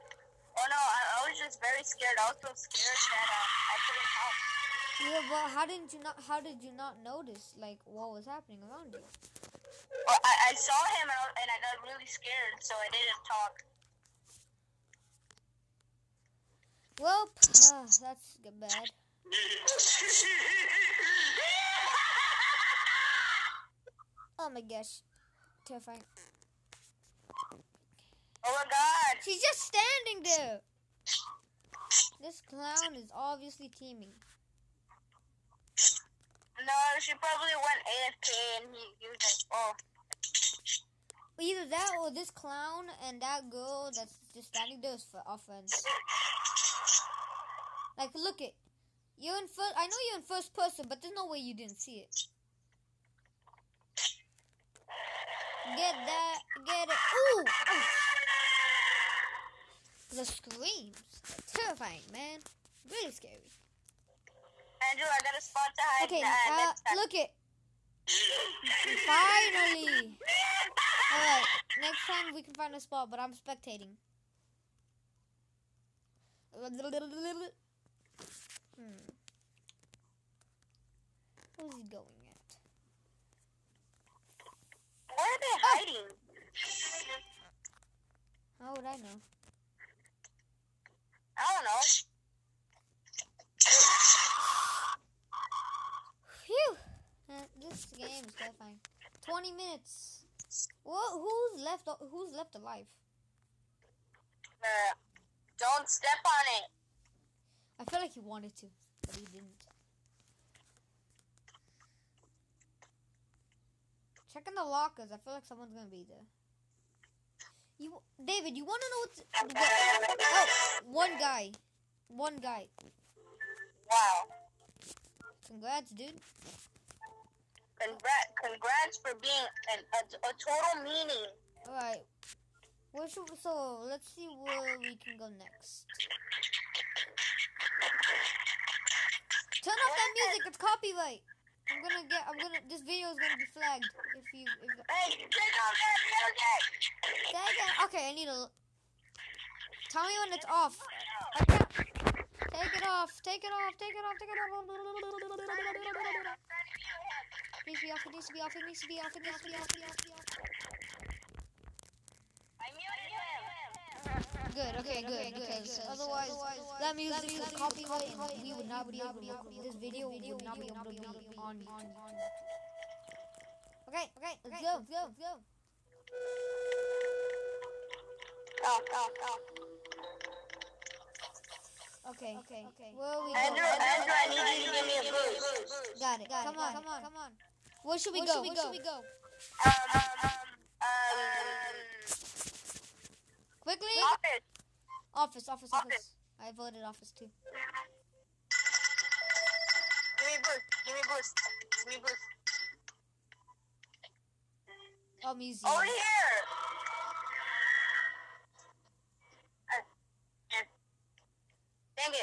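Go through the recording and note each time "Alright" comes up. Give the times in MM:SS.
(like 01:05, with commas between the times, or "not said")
01:11.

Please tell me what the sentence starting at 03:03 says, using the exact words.
Andrew, I need you to give me a boost.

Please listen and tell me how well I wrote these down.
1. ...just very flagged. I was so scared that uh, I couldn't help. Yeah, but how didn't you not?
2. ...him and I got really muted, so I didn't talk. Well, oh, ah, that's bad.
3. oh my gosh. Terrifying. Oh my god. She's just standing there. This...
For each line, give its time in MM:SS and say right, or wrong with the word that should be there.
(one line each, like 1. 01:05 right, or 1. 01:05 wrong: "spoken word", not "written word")
1. 00:01 wrong: "scared", not "flagged"
2. 00:10 wrong: "scared", not "muted"
3. 00:24 right.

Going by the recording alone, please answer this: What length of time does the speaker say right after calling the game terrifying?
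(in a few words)
20 minutes.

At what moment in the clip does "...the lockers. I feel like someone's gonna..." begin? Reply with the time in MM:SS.
01:54.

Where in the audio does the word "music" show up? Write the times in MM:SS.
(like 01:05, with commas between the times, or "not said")
02:20, 02:26, 02:46.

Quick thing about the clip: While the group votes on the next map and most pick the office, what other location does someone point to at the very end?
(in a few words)
museum.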